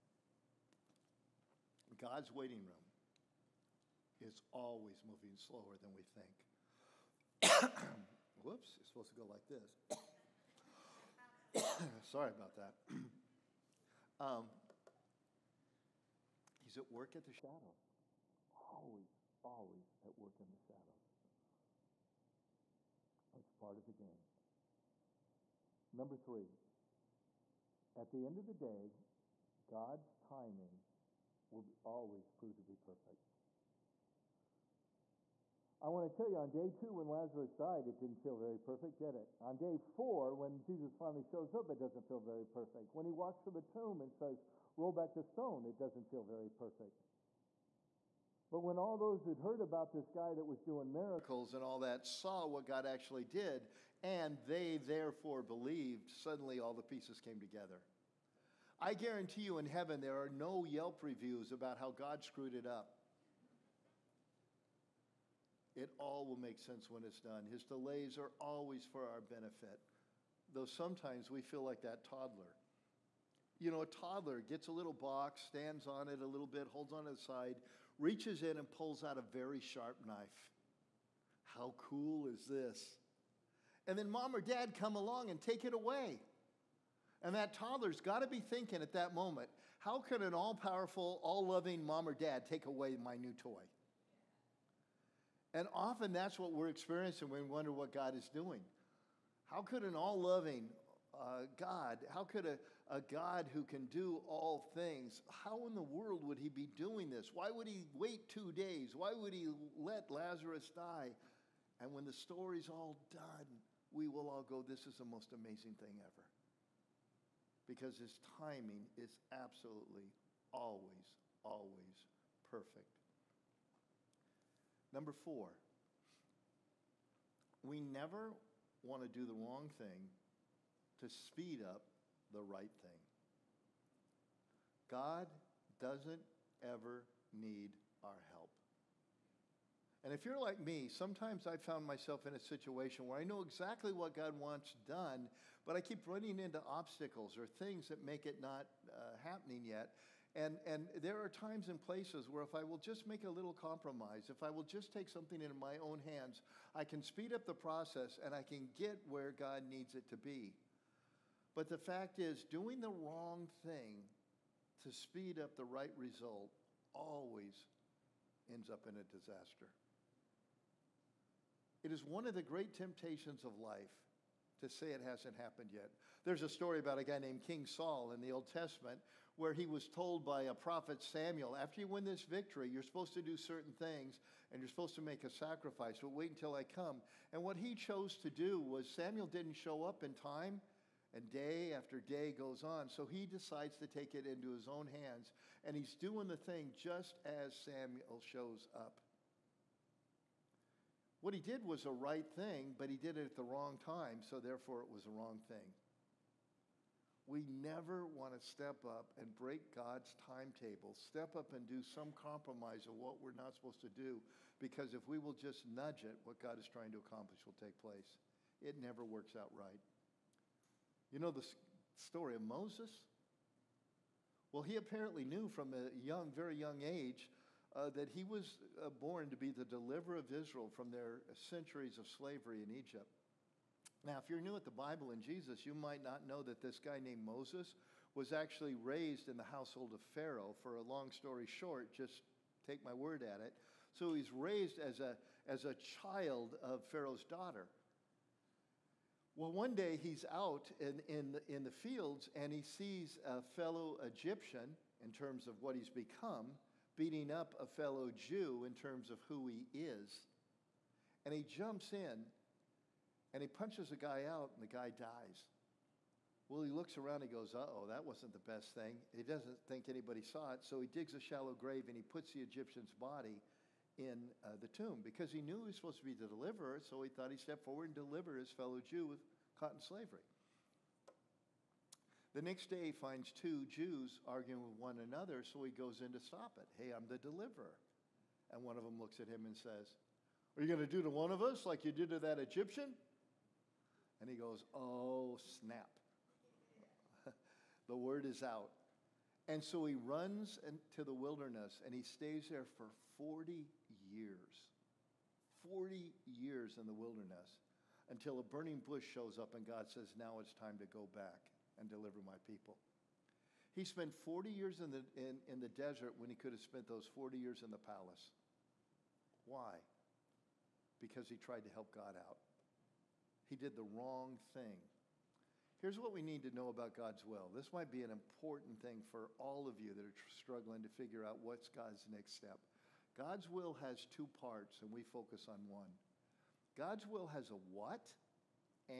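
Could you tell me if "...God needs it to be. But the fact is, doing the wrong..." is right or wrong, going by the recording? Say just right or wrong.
right.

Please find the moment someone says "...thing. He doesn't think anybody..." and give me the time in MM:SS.
04:28.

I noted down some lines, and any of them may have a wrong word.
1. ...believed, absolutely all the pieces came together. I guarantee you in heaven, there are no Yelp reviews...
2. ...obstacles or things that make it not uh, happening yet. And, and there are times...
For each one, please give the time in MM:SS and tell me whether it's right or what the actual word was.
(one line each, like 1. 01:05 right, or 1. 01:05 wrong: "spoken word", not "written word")
1. 00:55 wrong: "suddenly", not "absolutely"
2. 02:26 right.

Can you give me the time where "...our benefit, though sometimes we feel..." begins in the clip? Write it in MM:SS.
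01:09.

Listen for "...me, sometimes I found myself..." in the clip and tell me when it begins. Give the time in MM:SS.
02:20.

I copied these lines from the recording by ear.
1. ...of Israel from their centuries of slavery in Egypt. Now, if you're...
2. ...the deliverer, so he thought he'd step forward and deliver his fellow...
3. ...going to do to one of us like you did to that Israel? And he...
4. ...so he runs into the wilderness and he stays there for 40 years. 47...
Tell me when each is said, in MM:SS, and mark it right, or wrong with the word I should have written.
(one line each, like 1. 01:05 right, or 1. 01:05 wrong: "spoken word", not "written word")
1. 03:50 right
2. 04:36 right
3. 04:50 wrong: "Egyptian", not "Israel"
4. 04:59 wrong: "40", not "47".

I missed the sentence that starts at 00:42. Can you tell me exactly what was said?
When he walks to the tomb and says, Roll back the stone, it doesn't feel very perfect.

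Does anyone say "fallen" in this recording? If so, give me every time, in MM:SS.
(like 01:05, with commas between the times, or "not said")
not said.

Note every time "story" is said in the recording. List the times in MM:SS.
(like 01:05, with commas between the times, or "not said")
01:52, 02:56, 03:42, 04:01.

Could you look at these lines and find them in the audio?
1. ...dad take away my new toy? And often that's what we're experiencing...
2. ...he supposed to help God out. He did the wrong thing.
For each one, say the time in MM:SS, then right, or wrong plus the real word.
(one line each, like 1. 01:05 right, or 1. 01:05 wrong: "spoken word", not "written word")
1. 01:32 right
2. 05:21 wrong: "tried", not "supposed".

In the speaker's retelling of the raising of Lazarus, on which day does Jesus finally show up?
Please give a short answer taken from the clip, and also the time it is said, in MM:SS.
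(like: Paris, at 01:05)
Day 4, at 00:39.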